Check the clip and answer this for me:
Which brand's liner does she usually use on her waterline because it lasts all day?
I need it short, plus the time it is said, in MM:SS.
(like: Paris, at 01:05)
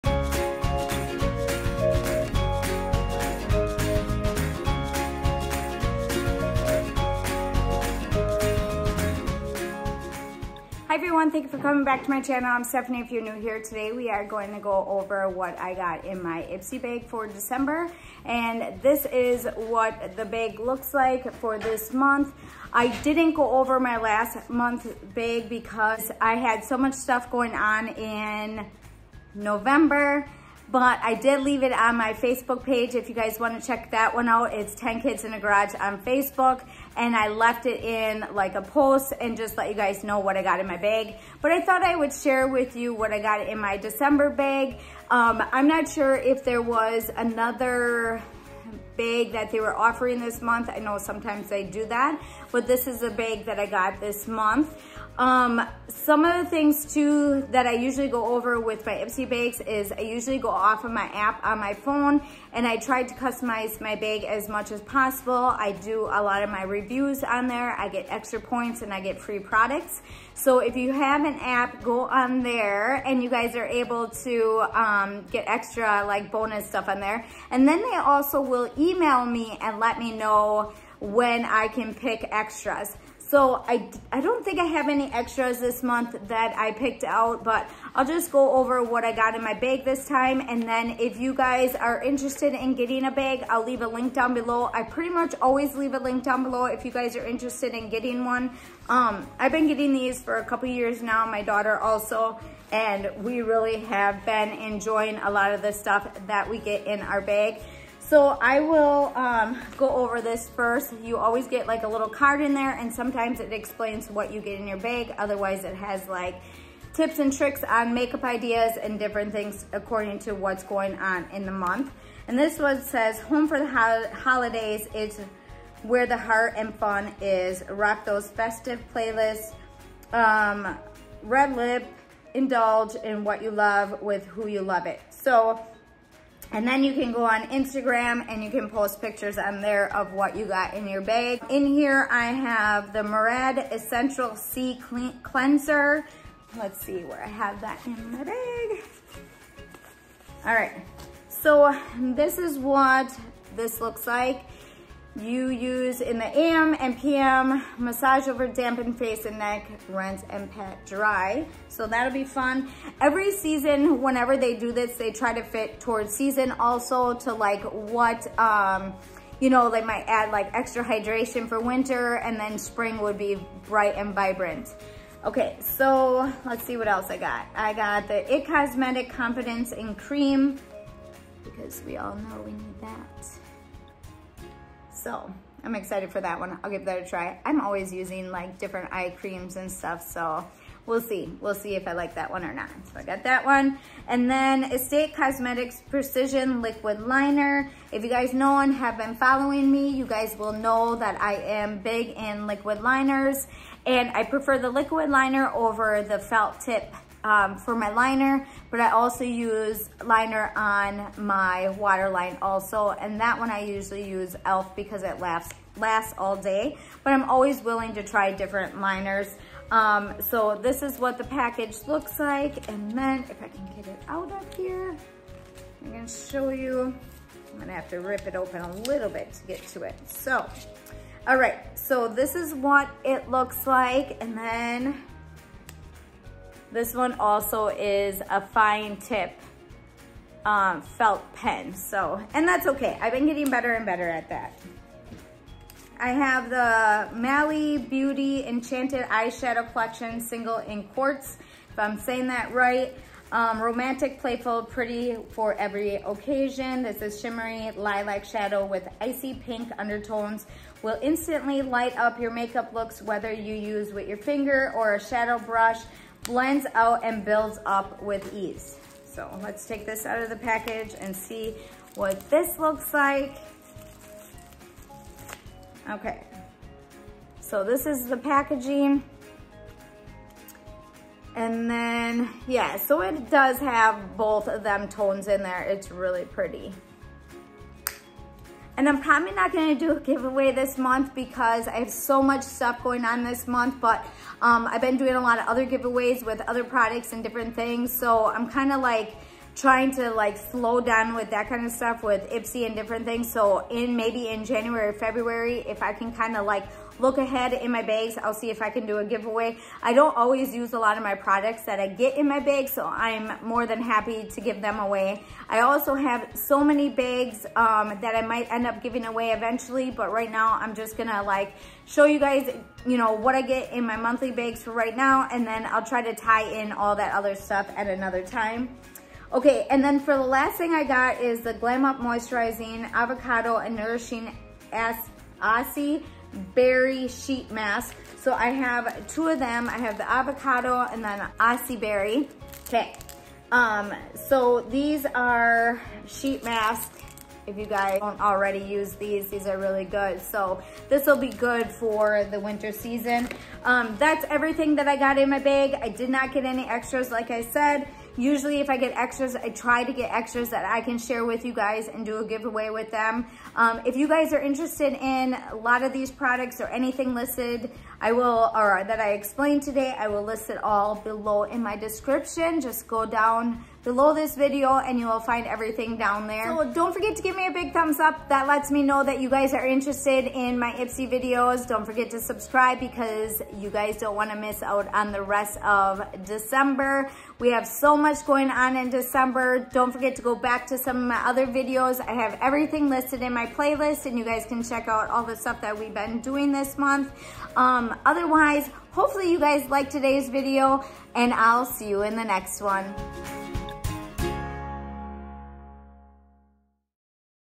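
e.l.f., at 03:34.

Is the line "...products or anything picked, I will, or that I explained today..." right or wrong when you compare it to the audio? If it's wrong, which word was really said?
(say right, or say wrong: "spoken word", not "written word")
wrong: "listed", not "picked".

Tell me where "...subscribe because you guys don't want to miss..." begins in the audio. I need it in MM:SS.
06:22.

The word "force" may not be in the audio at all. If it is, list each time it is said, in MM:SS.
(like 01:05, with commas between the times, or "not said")
not said.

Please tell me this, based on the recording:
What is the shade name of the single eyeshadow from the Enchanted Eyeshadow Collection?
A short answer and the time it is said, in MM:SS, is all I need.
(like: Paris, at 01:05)
Quartz, at 04:10.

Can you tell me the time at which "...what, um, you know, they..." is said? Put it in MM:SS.
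02:47.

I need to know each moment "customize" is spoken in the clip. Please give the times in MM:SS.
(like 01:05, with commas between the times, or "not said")
01:03.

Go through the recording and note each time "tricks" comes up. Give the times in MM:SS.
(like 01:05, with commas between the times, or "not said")
01:57.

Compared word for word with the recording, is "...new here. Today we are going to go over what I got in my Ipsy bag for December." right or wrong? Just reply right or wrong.
right.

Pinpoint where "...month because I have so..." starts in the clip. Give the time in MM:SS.
04:50.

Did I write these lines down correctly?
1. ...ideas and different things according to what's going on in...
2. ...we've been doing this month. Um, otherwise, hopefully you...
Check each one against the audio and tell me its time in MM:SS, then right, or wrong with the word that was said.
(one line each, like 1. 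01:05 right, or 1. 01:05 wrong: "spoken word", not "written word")
1. 01:58 right
2. 06:35 right.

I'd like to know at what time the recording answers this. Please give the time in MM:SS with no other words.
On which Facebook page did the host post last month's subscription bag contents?
00:34.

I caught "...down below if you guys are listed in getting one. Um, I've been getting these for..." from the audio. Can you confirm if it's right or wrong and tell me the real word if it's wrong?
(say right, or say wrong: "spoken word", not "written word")
wrong: "interested", not "listed".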